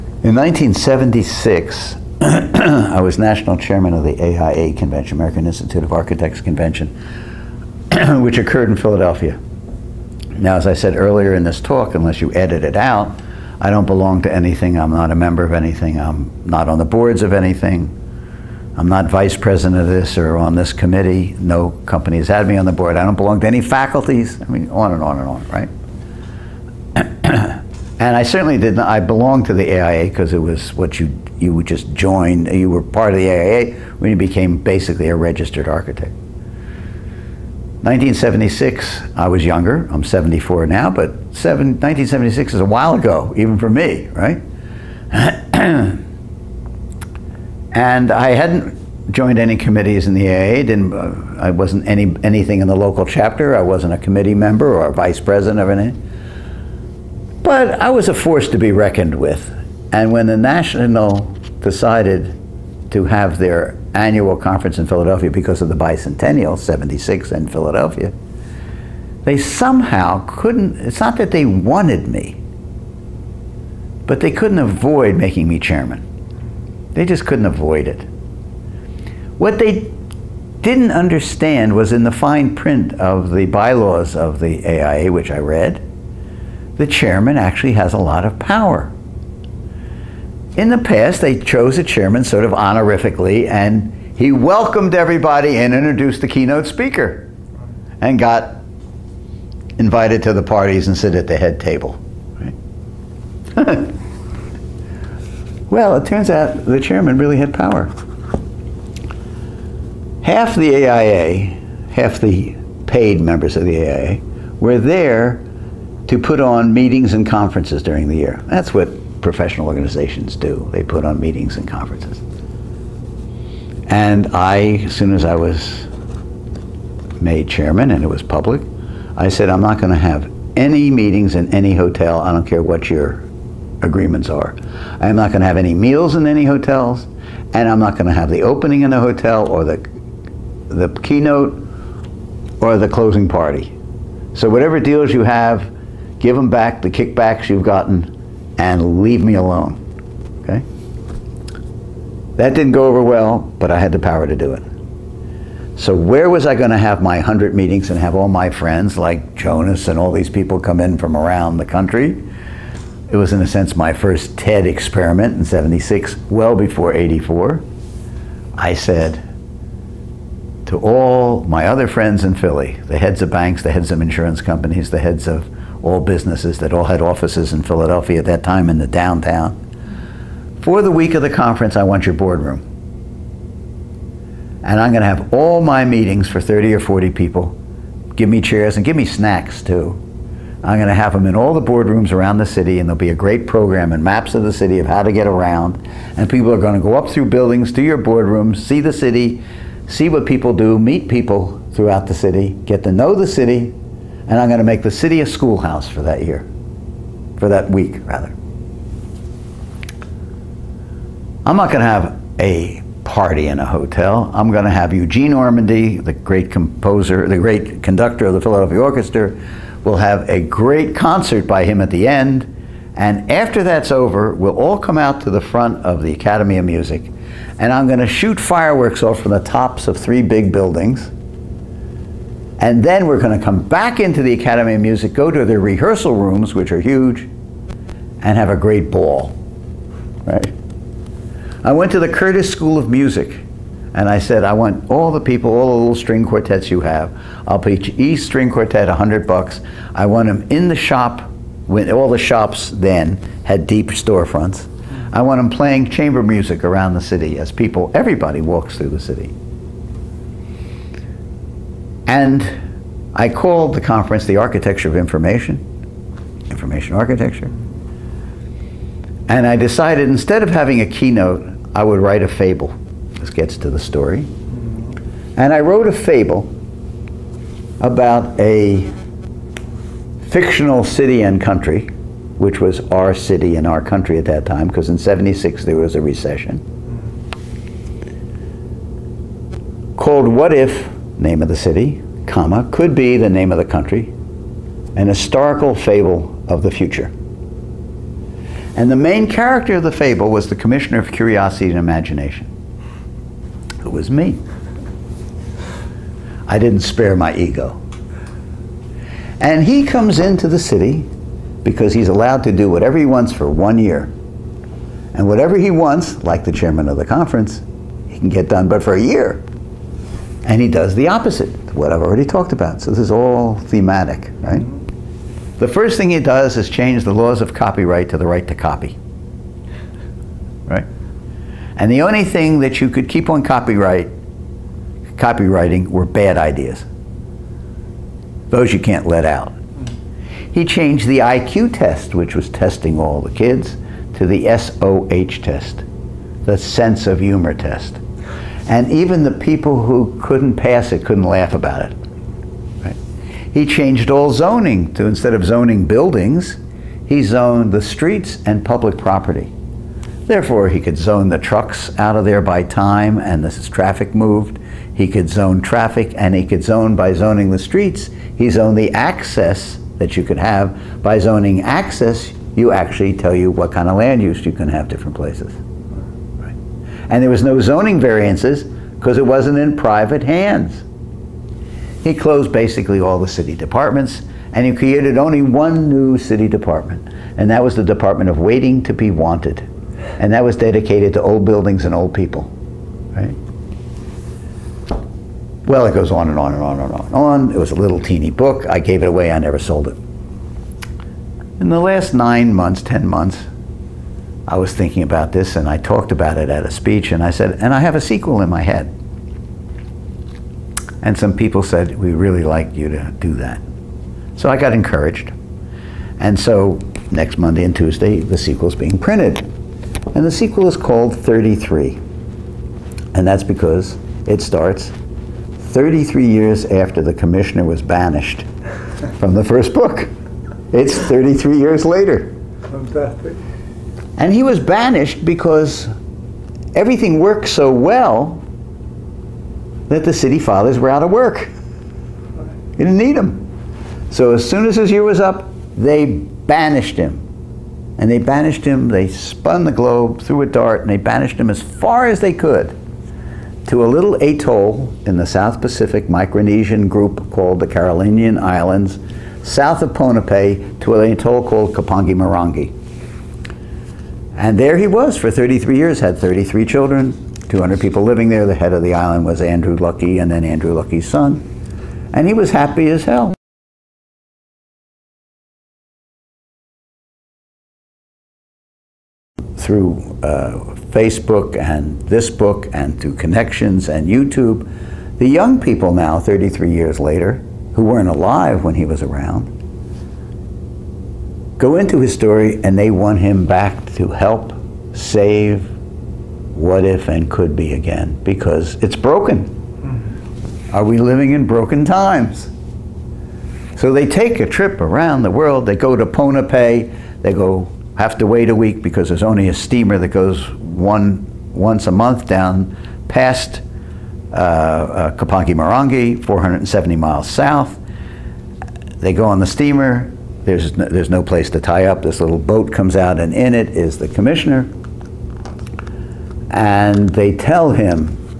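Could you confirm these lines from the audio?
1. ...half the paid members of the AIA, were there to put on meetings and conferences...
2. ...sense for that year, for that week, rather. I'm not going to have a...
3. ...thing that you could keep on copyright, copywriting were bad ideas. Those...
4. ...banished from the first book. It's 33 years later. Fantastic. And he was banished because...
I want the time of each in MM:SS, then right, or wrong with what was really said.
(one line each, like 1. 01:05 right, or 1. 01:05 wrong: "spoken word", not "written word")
1. 01:51 right
2. 03:25 wrong: "schoolhouse", not "sense"
3. 05:32 right
4. 07:07 right.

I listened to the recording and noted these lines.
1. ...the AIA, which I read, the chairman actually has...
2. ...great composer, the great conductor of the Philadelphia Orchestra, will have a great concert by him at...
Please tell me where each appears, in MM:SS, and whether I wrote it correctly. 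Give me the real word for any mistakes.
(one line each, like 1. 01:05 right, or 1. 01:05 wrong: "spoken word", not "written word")
1. 01:24 right
2. 03:36 right.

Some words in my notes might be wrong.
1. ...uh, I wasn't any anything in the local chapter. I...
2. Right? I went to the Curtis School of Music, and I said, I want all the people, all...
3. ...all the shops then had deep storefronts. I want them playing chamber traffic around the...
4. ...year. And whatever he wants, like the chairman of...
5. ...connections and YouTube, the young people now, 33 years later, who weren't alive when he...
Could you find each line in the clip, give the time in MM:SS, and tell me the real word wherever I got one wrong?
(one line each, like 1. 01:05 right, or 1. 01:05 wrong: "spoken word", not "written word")
1. 00:50 right
2. 04:00 right
3. 04:11 wrong: "music", not "traffic"
4. 05:13 right
5. 08:03 right.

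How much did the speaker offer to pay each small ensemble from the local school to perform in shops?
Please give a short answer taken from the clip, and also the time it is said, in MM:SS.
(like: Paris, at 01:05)
$100, at 04:08.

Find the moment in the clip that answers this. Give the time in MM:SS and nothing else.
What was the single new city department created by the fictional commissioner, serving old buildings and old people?
06:27.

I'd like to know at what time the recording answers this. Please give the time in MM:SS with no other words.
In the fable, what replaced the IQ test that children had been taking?
05:44.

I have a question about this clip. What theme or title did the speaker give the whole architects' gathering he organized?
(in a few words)
The architecture of information.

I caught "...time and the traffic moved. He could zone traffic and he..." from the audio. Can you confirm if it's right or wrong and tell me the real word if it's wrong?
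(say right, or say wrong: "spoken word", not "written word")
right.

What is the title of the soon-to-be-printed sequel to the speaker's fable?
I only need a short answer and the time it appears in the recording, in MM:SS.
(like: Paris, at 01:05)
33, at 07:00.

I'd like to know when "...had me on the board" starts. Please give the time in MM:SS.
00:22.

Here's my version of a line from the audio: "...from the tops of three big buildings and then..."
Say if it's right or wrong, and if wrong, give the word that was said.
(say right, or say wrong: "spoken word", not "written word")
right.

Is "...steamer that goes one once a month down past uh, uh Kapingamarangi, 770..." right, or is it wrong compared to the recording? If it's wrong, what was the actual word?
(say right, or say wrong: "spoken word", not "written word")
wrong: "470", not "770".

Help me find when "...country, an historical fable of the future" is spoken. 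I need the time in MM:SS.
04:53.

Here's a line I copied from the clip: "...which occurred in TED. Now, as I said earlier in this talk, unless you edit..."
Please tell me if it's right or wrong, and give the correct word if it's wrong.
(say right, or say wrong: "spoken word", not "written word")
wrong: "Philadelphia", not "TED".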